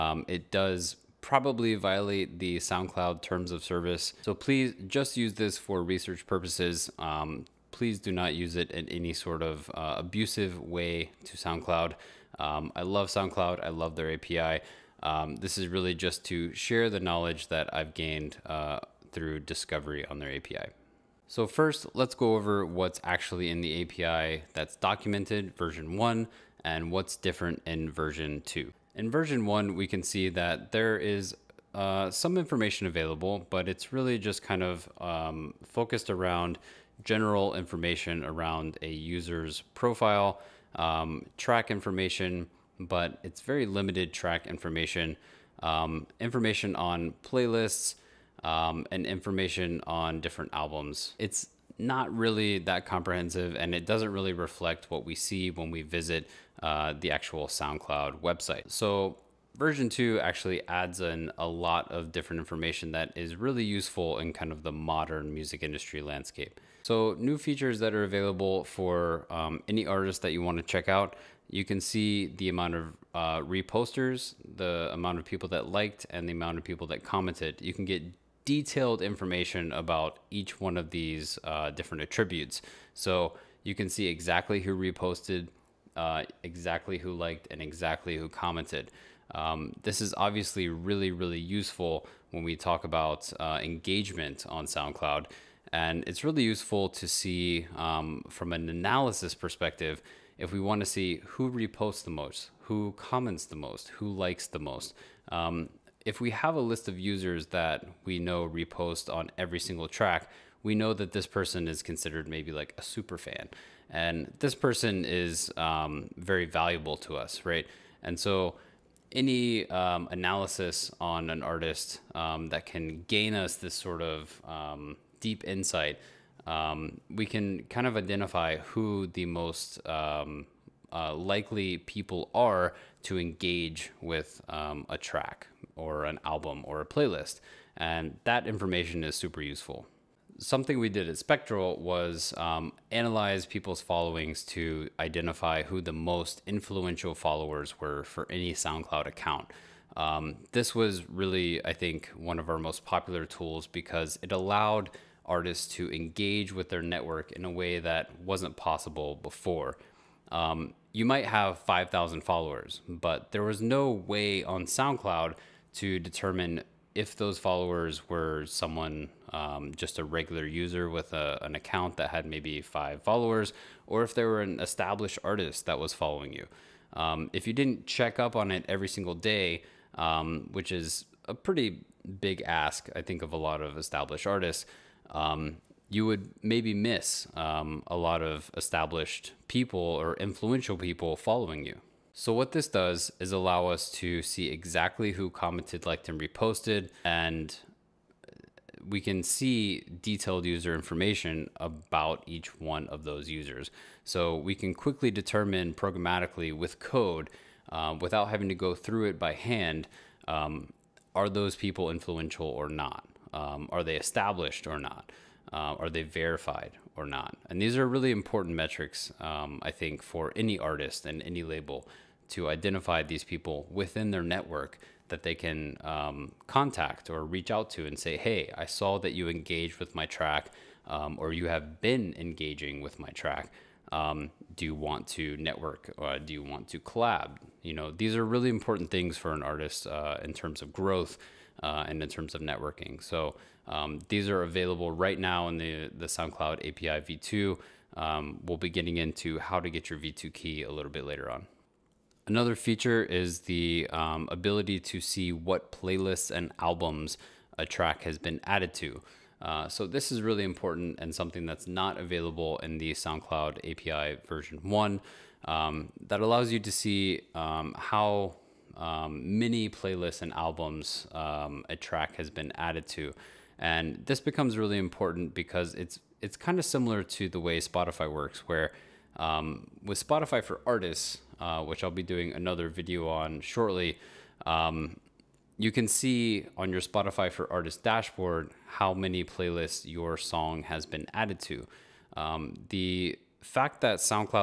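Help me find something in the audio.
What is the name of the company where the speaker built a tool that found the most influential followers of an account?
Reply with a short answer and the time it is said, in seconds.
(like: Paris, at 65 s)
Spectral, at 141 s.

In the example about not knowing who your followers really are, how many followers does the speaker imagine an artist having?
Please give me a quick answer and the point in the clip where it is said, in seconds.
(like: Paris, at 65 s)
5,000, at 161 s.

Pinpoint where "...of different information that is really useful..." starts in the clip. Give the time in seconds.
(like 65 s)
61 s.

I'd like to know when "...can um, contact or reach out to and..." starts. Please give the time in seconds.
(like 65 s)
225 s.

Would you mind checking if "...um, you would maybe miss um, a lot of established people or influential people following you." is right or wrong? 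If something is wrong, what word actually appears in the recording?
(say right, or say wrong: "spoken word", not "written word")
right.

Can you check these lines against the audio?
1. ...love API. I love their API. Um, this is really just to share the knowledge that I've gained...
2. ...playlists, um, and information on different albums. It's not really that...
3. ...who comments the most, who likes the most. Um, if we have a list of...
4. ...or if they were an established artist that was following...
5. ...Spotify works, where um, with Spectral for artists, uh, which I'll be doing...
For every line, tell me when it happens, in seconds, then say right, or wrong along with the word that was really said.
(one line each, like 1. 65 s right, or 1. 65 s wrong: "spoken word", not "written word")
1. 12 s wrong: "SoundCloud", not "API"
2. 47 s right
3. 102 s right
4. 173 s right
5. 277 s wrong: "Spotify", not "Spectral".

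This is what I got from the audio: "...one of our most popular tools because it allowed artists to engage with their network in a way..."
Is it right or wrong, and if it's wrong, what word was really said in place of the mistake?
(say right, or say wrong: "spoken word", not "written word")
right.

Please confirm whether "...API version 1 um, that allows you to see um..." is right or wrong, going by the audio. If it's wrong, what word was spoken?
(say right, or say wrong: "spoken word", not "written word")
right.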